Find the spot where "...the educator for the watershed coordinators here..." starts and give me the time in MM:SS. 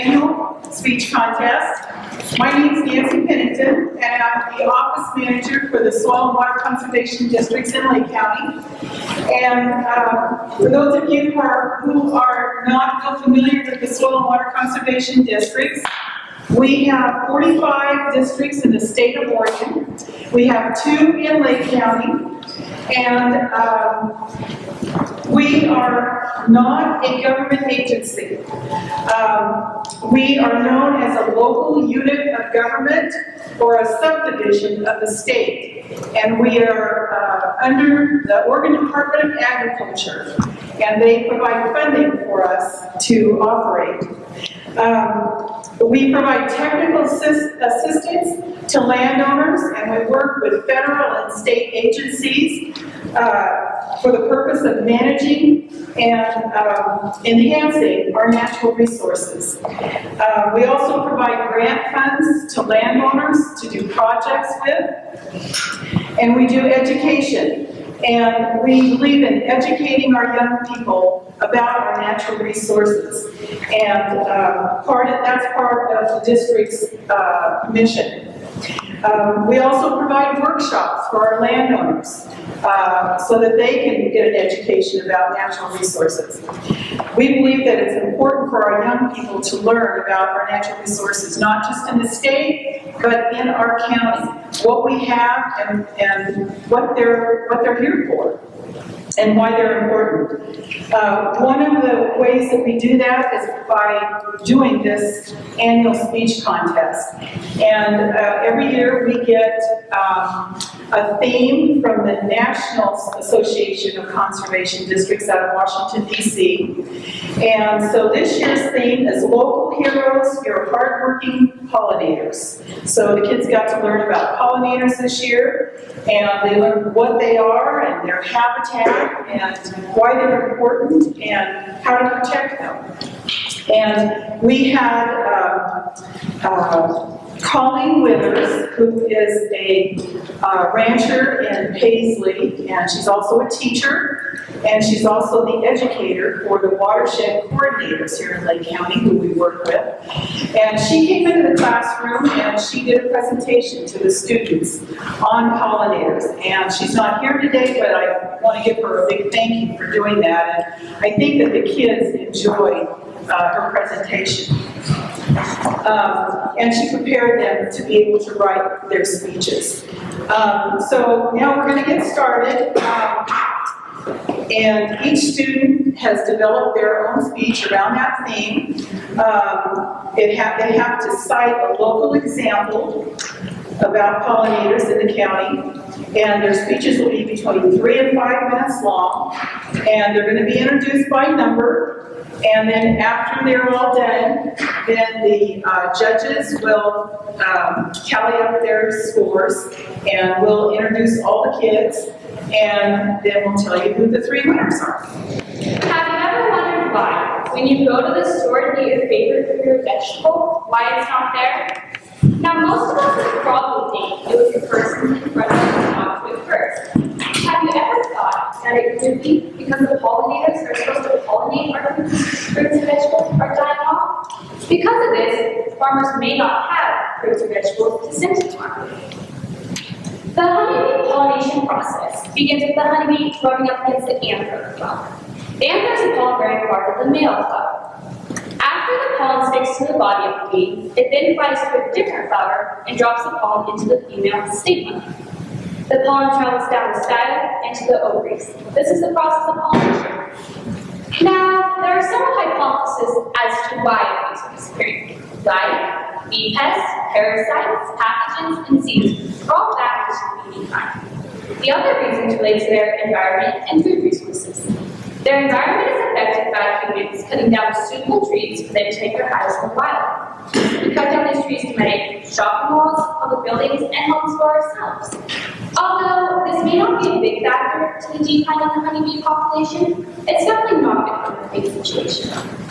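02:25.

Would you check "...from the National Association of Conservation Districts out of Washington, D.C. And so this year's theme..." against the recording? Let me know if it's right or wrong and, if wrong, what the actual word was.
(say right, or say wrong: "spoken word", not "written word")
right.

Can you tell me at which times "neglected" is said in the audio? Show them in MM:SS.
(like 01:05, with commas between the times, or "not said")
not said.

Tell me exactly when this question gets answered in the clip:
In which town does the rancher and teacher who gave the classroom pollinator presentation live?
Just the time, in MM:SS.
02:21.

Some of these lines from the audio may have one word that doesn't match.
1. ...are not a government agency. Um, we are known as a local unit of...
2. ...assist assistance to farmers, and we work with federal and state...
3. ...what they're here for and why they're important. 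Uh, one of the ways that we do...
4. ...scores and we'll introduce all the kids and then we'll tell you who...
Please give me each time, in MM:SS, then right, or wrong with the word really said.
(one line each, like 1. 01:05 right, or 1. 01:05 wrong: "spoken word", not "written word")
1. 00:25 right
2. 00:47 wrong: "landowners", not "farmers"
3. 01:37 right
4. 03:19 right.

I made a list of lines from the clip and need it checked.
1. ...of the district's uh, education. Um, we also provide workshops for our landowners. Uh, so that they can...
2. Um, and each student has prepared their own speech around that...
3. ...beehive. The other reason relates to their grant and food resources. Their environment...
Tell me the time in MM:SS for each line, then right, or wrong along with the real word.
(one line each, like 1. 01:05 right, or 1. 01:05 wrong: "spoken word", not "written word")
1. 01:15 wrong: "mission", not "education"
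2. 02:52 wrong: "developed", not "prepared"
3. 04:20 wrong: "environment", not "grant".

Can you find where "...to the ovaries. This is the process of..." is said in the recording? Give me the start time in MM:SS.
04:07.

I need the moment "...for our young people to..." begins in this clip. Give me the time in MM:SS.
01:28.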